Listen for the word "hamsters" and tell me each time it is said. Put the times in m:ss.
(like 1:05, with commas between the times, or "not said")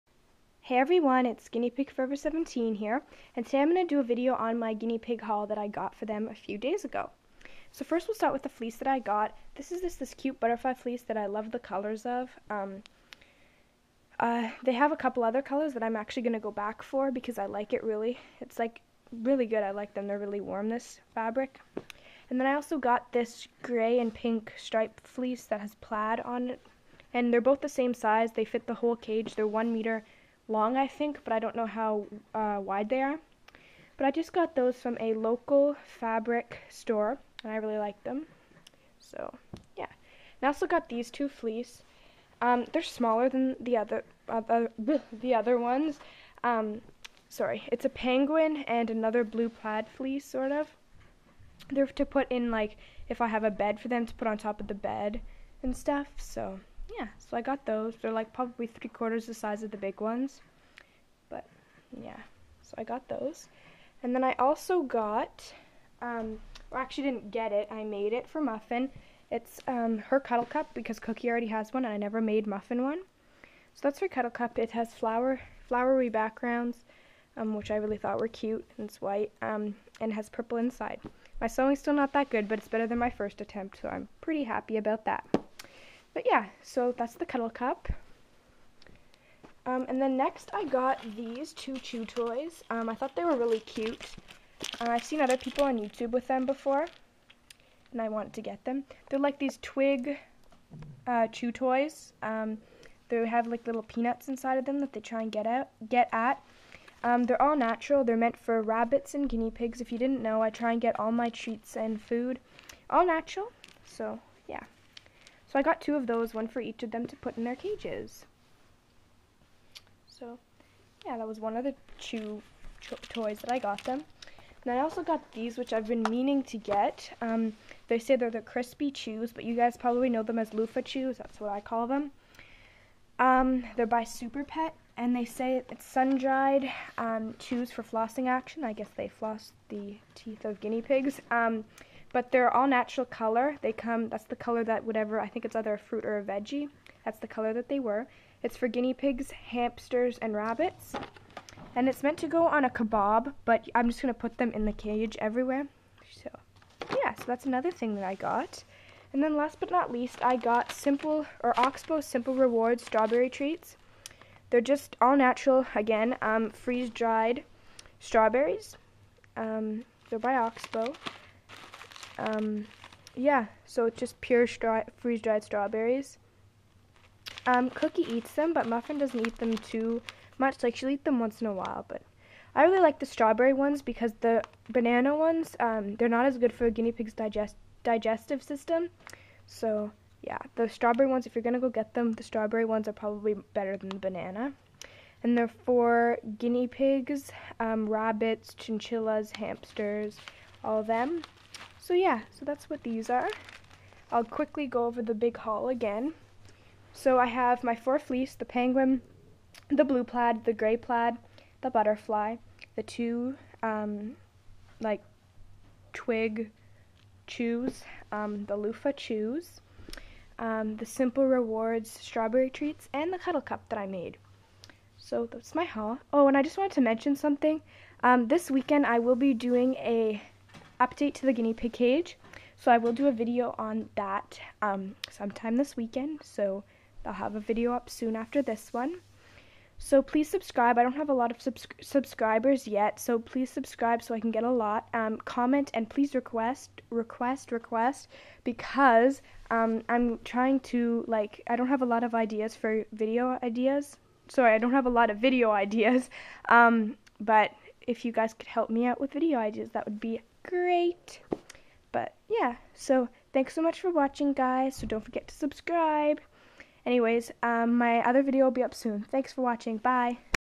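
2:29, 3:19.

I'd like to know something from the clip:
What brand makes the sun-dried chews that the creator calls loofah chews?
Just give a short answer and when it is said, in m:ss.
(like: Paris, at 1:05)
Super Pet, at 2:14.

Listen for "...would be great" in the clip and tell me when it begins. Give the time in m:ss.
4:19.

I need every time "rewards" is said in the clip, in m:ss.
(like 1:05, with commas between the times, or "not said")
2:42, 3:41.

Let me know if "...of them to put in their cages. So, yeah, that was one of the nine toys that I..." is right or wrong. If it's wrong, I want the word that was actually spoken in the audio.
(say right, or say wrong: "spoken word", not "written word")
wrong: "two", not "nine".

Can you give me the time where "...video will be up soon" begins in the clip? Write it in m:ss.
4:28.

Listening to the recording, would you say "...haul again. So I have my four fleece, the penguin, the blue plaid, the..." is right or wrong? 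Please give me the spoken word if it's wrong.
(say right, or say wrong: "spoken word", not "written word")
right.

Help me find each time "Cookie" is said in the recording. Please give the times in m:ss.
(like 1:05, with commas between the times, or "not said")
1:10, 2:57.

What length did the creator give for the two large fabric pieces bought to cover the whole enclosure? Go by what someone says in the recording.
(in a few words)
1 meter.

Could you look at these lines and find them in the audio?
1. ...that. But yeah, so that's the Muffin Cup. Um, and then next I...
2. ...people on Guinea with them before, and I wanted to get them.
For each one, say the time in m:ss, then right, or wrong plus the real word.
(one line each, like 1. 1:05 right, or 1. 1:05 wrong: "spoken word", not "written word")
1. 1:25 wrong: "Cuddle", not "Muffin"
2. 1:35 wrong: "YouTube", not "Guinea".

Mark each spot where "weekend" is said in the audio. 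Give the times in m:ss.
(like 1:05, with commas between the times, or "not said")
3:48, 3:55.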